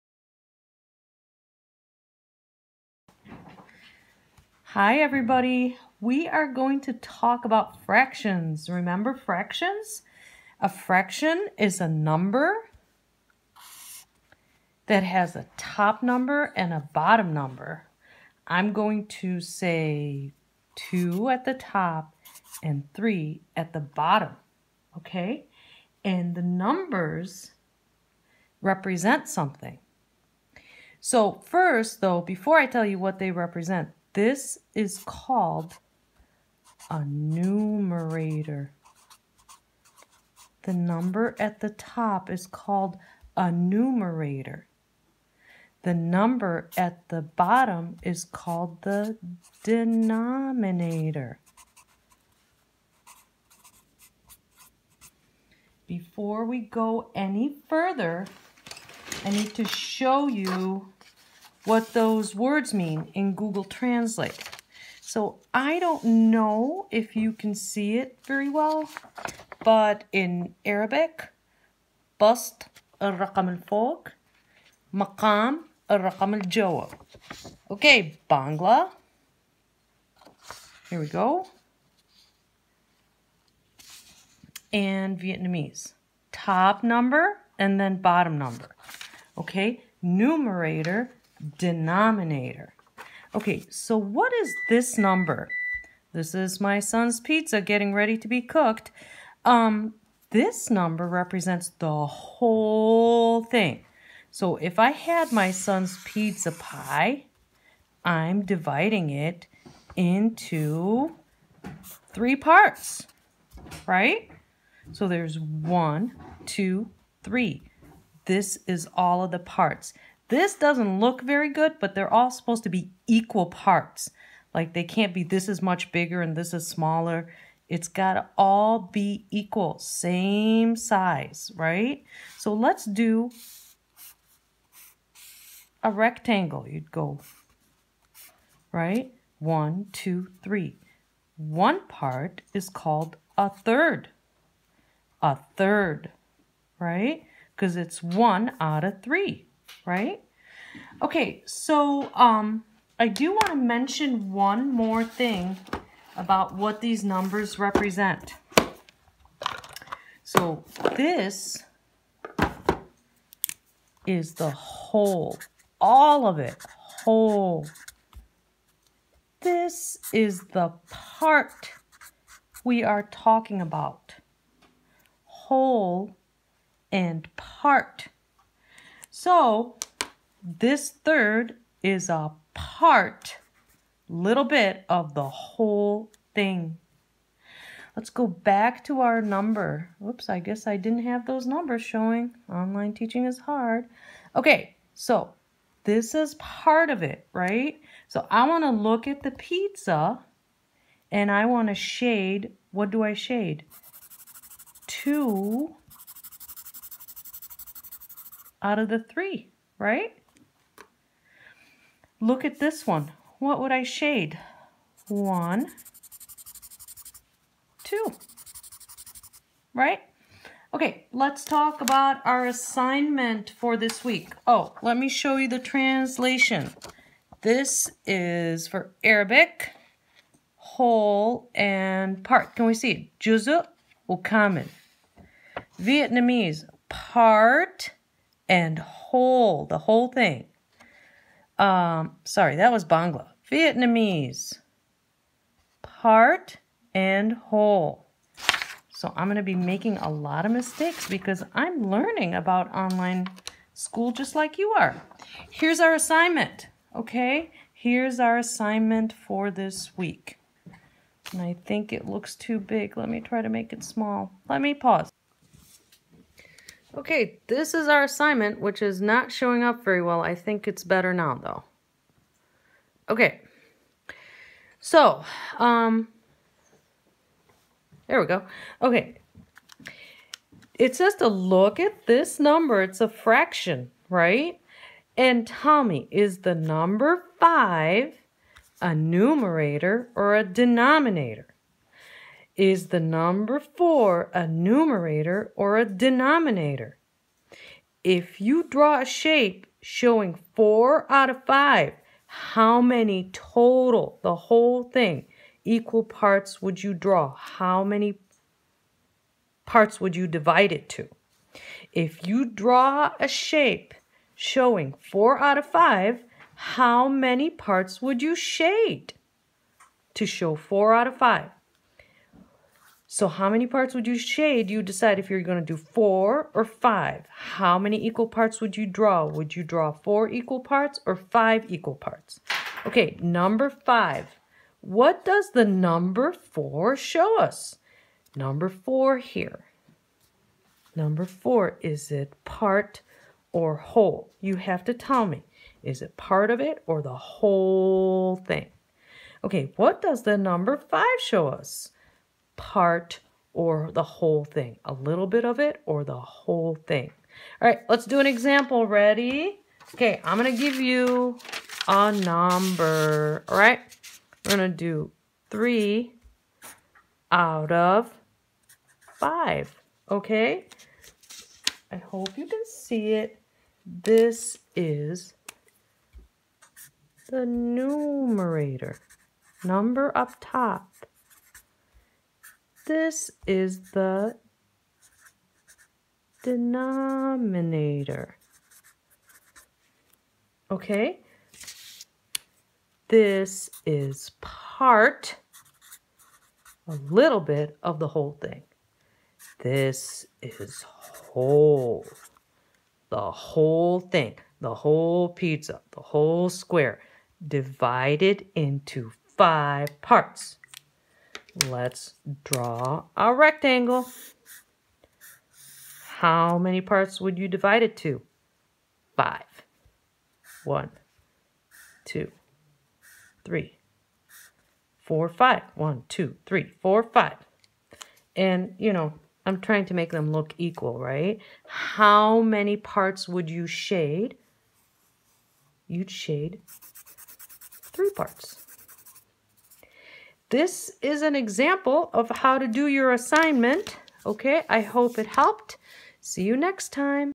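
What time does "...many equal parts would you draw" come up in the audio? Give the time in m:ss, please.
5:27.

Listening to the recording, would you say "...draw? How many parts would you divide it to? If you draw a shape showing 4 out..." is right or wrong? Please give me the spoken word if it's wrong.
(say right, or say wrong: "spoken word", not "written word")
right.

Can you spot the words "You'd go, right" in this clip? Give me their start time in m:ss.
2:16.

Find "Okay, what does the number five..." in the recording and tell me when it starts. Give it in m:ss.
5:49.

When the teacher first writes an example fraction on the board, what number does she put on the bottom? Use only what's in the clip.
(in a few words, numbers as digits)
3.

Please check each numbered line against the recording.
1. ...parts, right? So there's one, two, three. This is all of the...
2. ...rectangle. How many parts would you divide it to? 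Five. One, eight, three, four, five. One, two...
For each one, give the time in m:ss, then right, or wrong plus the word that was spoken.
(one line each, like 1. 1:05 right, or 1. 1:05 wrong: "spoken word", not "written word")
1. 1:52 right
2. 6:53 wrong: "two", not "eight".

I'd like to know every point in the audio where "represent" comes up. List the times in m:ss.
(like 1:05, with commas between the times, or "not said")
0:28, 0:33, 1:41, 2:37.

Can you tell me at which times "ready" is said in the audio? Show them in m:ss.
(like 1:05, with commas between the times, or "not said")
1:37, 5:58.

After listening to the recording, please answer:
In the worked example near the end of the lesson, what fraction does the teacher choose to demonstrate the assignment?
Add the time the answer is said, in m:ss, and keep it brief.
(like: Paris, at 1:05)
3 out of 5, at 6:05.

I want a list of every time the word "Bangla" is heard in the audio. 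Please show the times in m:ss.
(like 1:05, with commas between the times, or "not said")
1:18, 4:02.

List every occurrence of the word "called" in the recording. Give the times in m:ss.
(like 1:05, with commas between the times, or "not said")
0:35, 0:42, 0:48, 2:22.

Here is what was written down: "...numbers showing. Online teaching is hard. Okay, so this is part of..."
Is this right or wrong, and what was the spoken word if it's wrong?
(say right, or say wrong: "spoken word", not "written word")
right.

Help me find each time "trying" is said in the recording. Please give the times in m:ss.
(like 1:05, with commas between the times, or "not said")
7:09.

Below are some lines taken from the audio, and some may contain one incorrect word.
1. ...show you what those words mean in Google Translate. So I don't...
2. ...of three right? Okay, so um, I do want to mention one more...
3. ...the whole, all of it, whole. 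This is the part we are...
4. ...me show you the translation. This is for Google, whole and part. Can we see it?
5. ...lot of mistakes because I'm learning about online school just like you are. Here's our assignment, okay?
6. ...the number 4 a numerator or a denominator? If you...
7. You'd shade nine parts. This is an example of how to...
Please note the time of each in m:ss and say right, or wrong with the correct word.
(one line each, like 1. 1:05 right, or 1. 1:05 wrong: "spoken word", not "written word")
1. 0:59 right
2. 2:28 right
3. 2:44 right
4. 3:44 wrong: "Arabic", not "Google"
5. 4:10 right
6. 4:52 right
7. 7:15 wrong: "three", not "nine".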